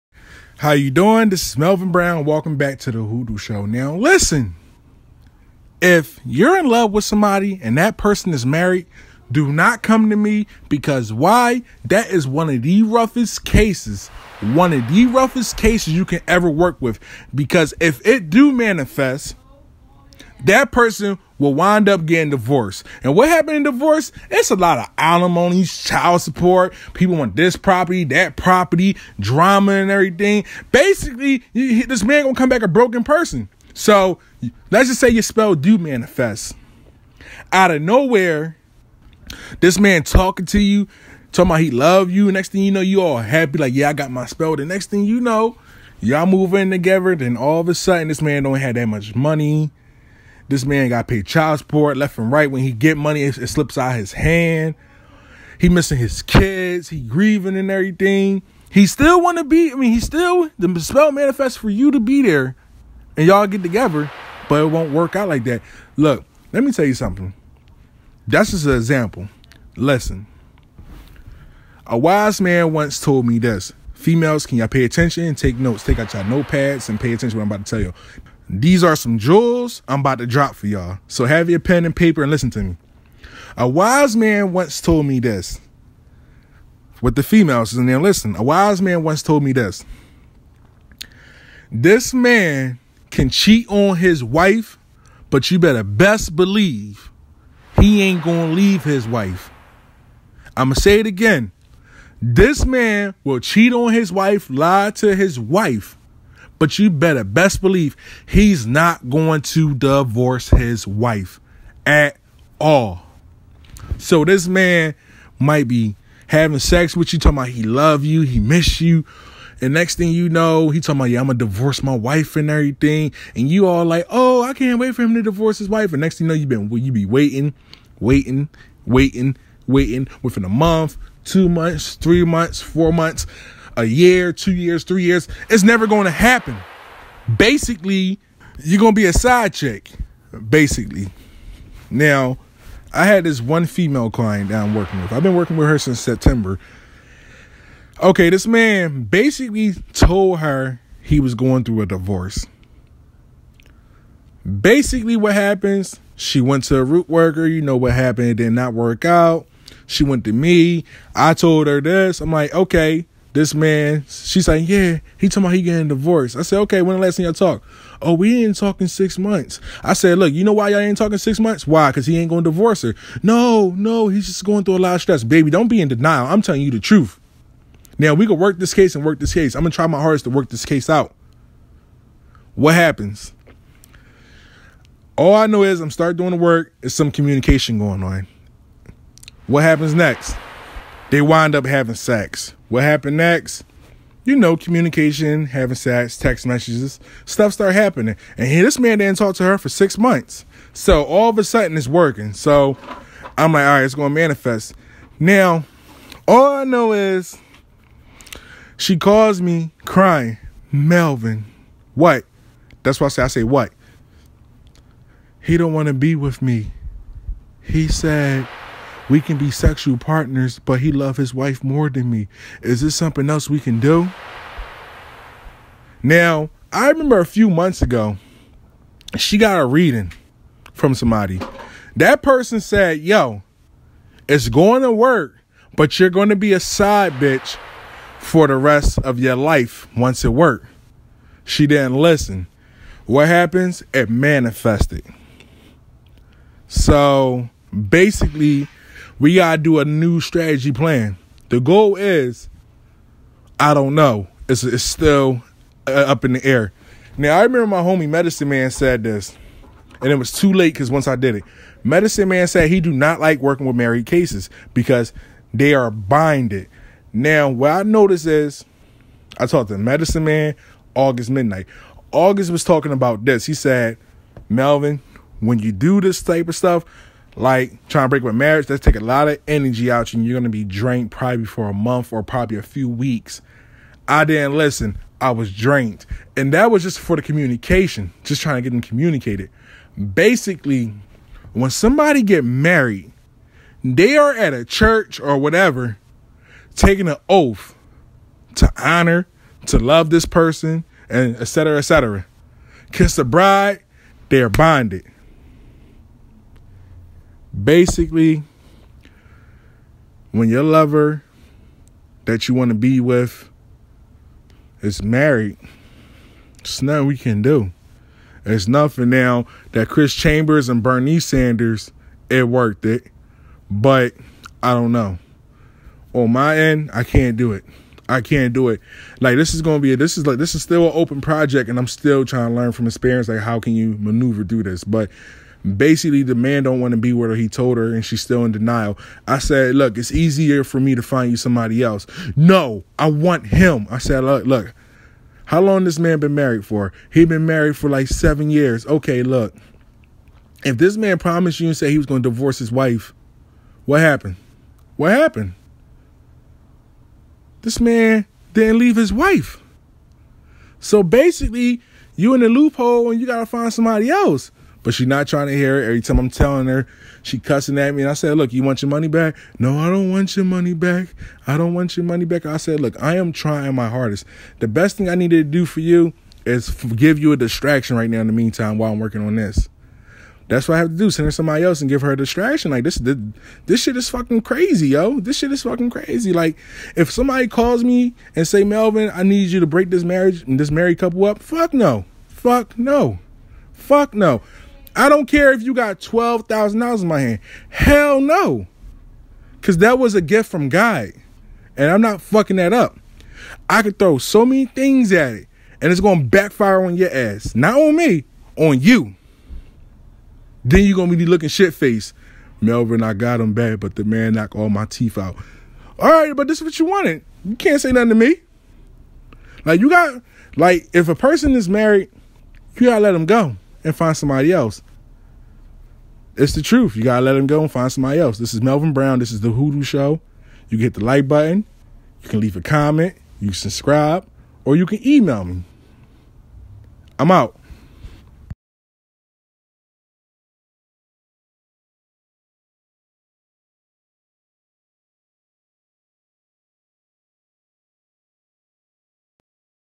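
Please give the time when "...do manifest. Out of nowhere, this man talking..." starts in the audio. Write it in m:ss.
0:35.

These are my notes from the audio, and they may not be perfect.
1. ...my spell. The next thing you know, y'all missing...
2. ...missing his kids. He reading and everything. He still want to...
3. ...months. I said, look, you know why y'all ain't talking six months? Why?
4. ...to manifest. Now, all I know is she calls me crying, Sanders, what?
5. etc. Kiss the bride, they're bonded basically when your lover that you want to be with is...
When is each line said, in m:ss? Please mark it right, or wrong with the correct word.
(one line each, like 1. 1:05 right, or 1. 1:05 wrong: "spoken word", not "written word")
1. 0:44 wrong: "moving", not "missing"
2. 0:55 wrong: "grieving", not "reading"
3. 2:49 right
4. 3:24 wrong: "Melvin", not "Sanders"
5. 5:01 right.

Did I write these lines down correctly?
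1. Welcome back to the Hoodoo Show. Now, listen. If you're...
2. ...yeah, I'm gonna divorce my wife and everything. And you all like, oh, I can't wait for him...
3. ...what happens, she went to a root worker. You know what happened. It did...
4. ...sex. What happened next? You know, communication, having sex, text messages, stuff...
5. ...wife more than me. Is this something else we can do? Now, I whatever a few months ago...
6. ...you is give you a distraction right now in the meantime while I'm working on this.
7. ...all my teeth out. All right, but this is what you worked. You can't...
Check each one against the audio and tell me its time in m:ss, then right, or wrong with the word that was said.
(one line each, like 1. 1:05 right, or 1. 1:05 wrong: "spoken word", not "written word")
1. 0:02 right
2. 2:01 right
3. 2:35 right
4. 3:11 right
5. 3:41 wrong: "remember", not "whatever"
6. 6:15 right
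7. 6:54 wrong: "wanted", not "worked".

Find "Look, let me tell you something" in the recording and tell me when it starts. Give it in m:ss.
1:05.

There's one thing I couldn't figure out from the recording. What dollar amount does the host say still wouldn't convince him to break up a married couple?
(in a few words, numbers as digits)
$12,000.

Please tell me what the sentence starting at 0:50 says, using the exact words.
This man got paid child support left and right.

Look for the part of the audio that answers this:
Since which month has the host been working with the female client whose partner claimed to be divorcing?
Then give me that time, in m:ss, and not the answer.
2:25.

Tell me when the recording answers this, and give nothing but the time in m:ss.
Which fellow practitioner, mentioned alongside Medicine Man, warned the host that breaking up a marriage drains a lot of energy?
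4:30.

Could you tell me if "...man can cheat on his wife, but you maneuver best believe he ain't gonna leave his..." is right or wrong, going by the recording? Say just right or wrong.
wrong.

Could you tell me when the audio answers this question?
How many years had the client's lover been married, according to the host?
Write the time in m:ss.
5:48.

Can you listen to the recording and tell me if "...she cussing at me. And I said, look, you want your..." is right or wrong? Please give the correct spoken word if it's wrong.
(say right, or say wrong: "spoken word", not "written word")
right.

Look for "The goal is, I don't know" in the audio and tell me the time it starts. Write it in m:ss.
4:11.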